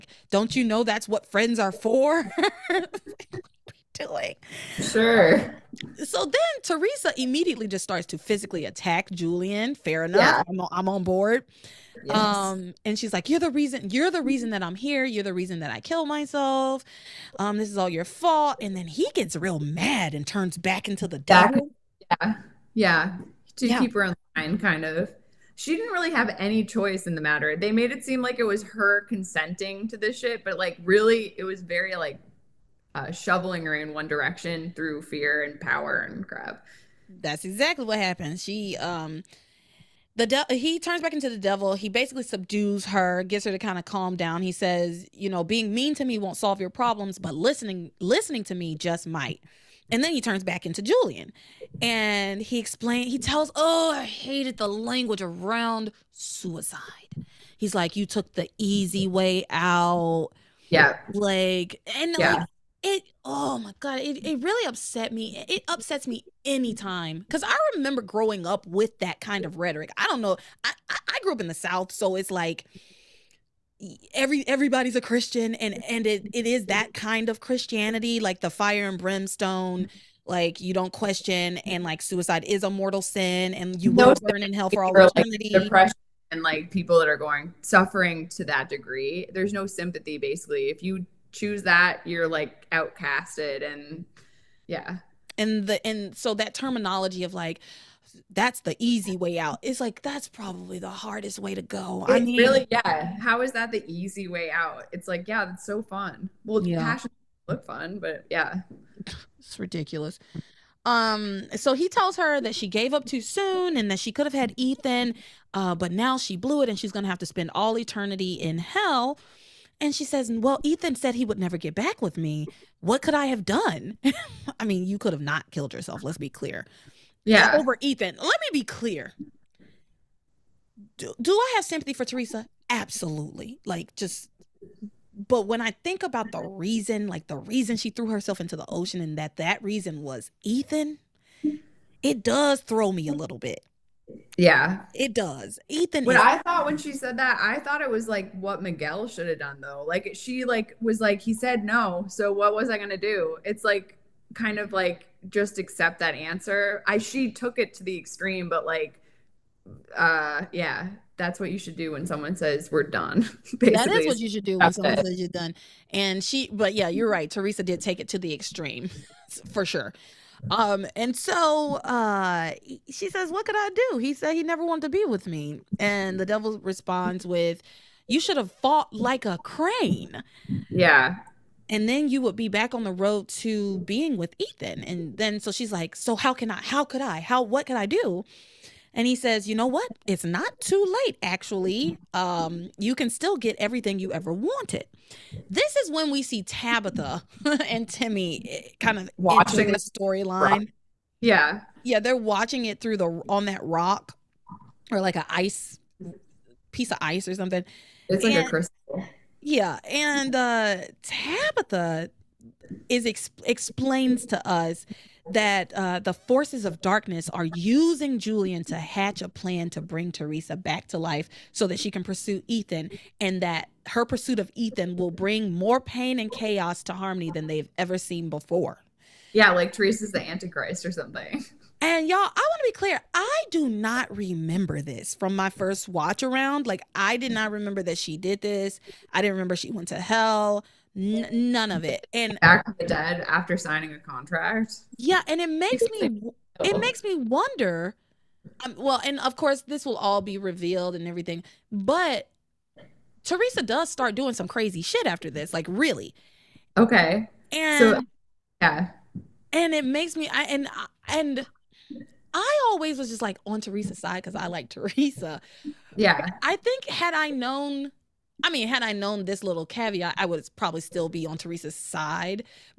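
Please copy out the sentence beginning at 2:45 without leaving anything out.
And she but yeah, you're right.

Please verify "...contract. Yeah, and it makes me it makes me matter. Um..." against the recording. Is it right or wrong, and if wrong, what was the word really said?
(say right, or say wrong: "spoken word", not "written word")
wrong: "wonder", not "matter".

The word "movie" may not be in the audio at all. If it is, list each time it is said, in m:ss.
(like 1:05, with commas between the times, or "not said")
not said.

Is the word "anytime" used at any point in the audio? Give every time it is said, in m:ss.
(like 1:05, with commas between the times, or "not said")
1:06.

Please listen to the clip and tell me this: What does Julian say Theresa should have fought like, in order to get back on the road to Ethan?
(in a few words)
A crane.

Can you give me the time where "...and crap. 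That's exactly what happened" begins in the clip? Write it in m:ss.
0:36.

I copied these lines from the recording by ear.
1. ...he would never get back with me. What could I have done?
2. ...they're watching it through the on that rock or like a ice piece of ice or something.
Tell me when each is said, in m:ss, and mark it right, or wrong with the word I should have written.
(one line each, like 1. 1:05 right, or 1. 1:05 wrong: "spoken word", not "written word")
1. 2:01 right
2. 3:21 right.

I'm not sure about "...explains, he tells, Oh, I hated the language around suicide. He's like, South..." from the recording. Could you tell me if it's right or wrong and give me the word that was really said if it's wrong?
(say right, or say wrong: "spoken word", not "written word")
wrong: "You", not "South".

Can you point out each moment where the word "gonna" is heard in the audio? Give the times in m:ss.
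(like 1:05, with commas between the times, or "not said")
1:56, 2:32.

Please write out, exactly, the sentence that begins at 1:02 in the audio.
like, it, oh my God, it, it really upset me.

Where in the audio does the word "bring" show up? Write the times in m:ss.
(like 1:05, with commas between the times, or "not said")
3:39, 3:45.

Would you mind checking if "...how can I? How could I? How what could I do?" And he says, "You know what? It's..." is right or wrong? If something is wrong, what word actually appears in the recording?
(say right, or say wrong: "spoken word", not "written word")
right.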